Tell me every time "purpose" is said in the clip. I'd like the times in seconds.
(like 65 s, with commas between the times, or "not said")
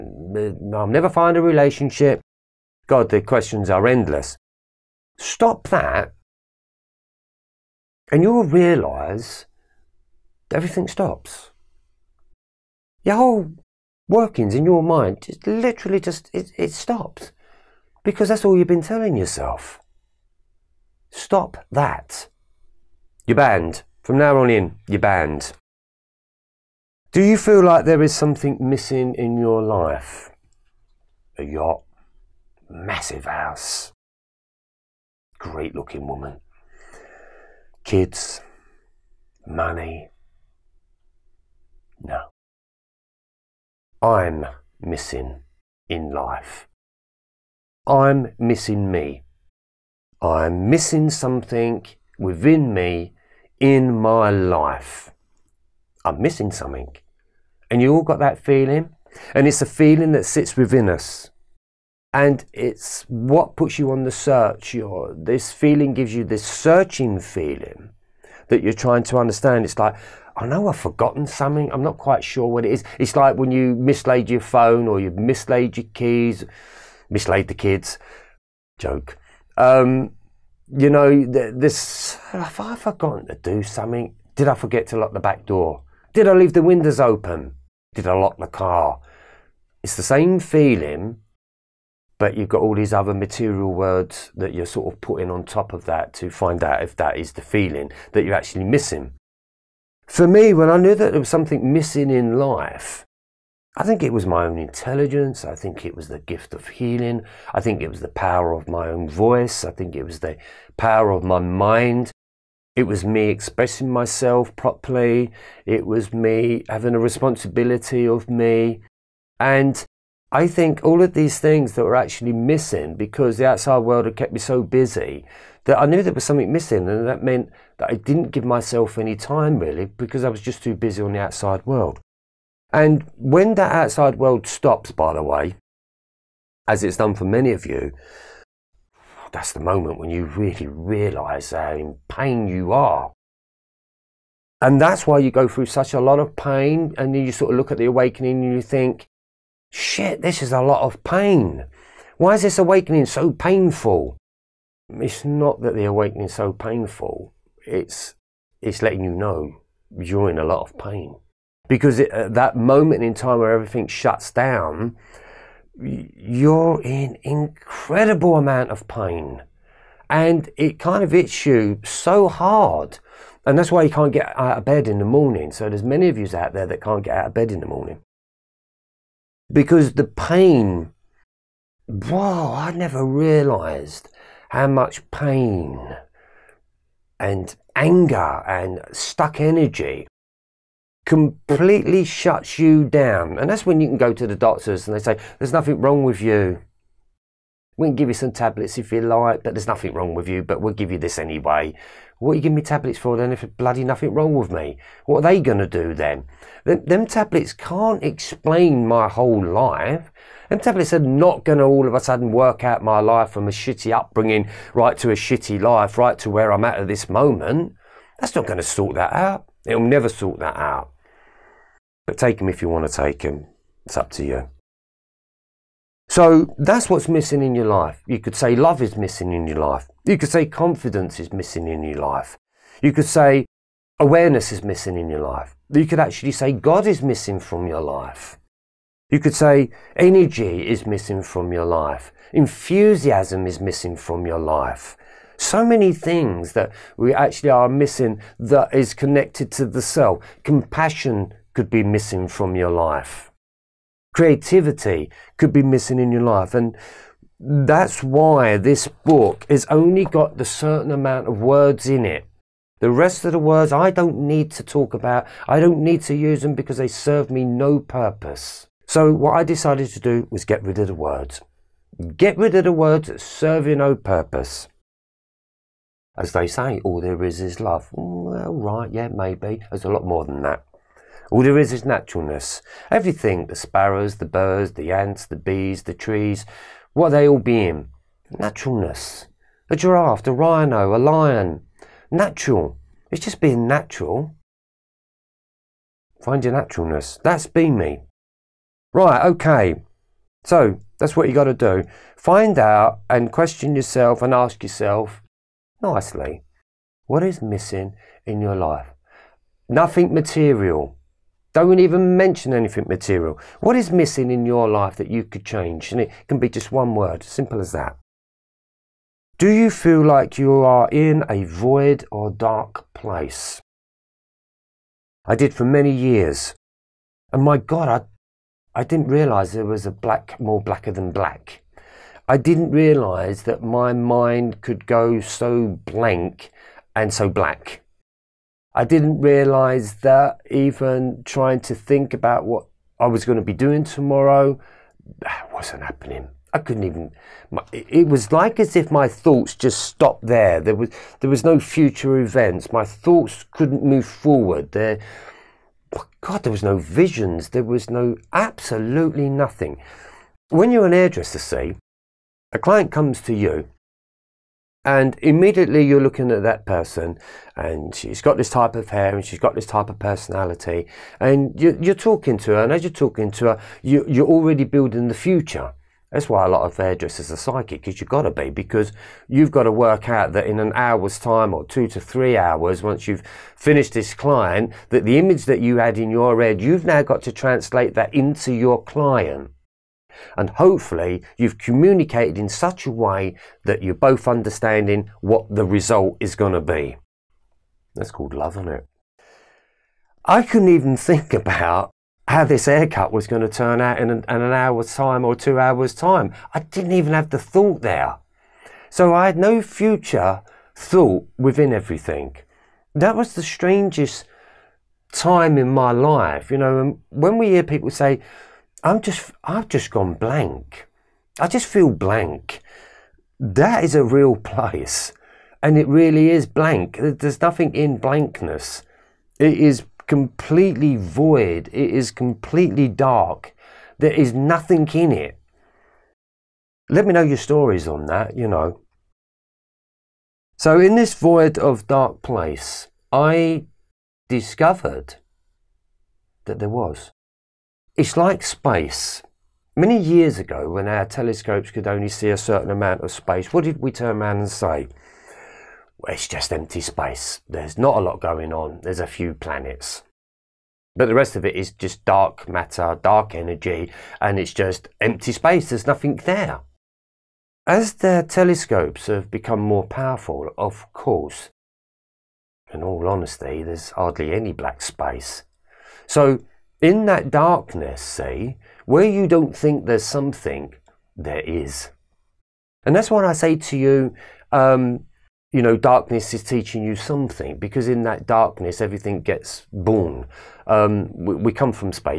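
267 s, 273 s.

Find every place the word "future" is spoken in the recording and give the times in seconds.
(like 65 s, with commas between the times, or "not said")
351 s, 375 s, 409 s.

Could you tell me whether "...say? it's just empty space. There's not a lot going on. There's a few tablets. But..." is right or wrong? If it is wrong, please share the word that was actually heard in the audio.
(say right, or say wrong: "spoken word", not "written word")
wrong: "planets", not "tablets".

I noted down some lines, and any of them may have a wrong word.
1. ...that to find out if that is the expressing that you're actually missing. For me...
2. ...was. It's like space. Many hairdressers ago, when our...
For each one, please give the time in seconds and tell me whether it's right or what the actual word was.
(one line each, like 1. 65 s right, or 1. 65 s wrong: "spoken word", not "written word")
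1. 95 s wrong: "feeling", not "expressing"
2. 446 s wrong: "years", not "hairdressers".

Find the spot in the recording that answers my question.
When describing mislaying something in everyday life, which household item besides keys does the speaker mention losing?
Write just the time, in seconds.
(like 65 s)
74 s.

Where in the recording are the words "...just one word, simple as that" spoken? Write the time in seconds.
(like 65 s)
316 s.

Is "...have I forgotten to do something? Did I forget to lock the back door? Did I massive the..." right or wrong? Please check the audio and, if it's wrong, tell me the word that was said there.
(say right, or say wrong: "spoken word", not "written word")
wrong: "leave", not "massive".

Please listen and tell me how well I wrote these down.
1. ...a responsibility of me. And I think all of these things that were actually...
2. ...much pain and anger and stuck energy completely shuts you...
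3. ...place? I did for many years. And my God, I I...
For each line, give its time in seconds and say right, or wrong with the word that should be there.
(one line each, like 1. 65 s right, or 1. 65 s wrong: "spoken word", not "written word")
1. 116 s right
2. 184 s right
3. 322 s right.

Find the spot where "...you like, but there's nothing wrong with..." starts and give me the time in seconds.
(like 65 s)
198 s.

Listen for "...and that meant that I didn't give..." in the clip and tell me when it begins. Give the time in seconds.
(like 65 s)
126 s.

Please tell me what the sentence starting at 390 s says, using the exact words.
And hopefully, you've communicated in such a way that you're both understanding what the result is going to be.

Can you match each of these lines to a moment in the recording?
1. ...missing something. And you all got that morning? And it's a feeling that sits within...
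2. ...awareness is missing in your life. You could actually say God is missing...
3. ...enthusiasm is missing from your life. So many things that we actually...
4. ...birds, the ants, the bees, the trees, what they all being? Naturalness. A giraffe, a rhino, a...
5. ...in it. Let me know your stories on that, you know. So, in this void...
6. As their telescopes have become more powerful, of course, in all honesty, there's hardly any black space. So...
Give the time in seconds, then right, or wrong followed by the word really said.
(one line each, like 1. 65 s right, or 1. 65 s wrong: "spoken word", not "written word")
1. 56 s wrong: "feeling", not "morning"
2. 233 s right
3. 242 s right
4. 284 s right
5. 434 s right
6. 467 s right.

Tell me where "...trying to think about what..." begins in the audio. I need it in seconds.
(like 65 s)
341 s.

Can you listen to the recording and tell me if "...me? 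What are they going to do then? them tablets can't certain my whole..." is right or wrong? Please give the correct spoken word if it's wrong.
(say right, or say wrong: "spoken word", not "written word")
wrong: "explain", not "certain".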